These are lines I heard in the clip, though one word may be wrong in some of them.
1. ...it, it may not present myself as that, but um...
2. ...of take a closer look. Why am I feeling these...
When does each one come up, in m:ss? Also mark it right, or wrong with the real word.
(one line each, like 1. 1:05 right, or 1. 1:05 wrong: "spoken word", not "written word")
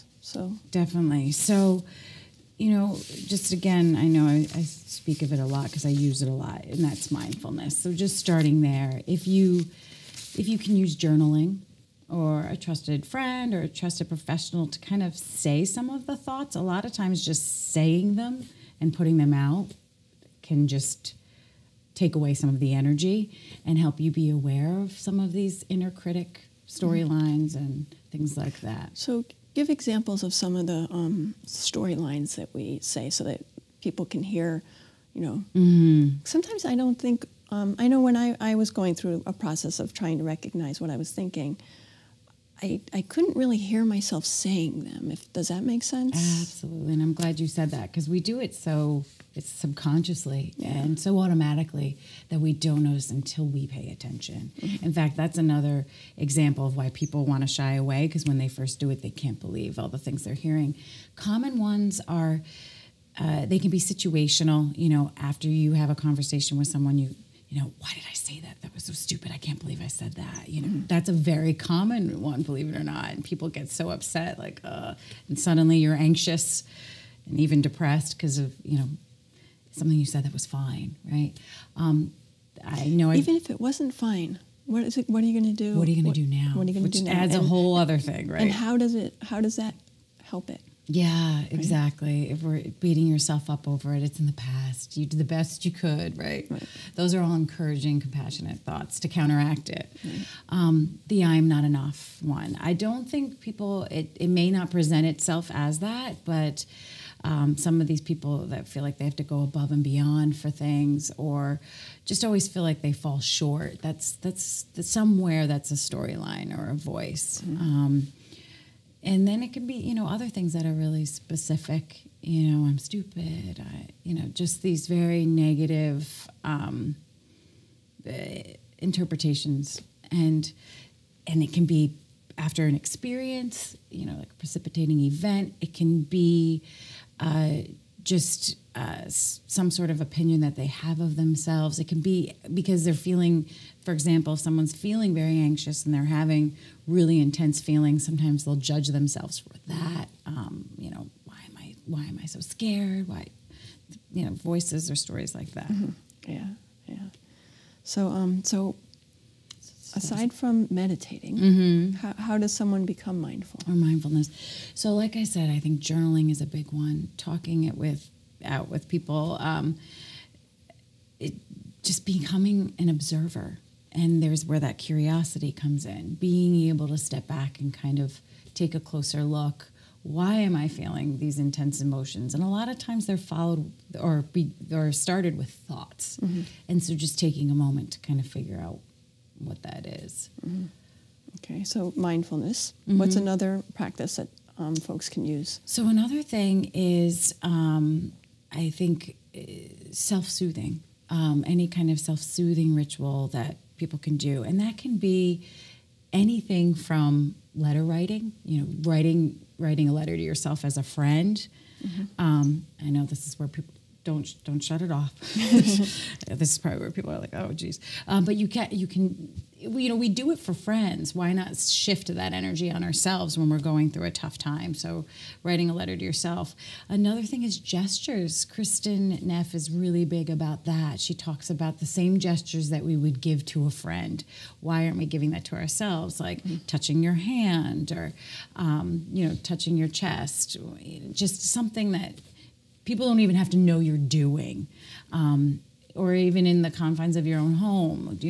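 1. 1:43 wrong: "itself", not "myself"
2. 2:57 right.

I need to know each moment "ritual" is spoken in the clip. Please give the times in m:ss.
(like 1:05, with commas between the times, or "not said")
3:22.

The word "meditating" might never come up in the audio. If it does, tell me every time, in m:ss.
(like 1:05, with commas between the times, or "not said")
2:40.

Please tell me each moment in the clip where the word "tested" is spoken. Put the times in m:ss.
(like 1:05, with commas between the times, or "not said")
not said.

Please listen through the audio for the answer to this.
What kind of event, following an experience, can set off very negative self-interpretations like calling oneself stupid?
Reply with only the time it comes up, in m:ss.
2:14.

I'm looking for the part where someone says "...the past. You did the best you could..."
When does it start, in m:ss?
1:34.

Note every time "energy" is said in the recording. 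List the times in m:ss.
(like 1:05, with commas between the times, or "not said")
0:22, 3:42.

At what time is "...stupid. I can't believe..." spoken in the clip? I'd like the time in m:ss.
1:08.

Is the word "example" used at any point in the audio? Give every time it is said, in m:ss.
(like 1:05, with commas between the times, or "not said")
0:29, 0:56, 2:23.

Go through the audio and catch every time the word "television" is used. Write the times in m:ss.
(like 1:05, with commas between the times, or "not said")
not said.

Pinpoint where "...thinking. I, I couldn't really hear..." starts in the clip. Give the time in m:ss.
0:41.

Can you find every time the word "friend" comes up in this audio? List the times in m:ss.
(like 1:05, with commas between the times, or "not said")
0:13, 3:30, 3:40, 3:53.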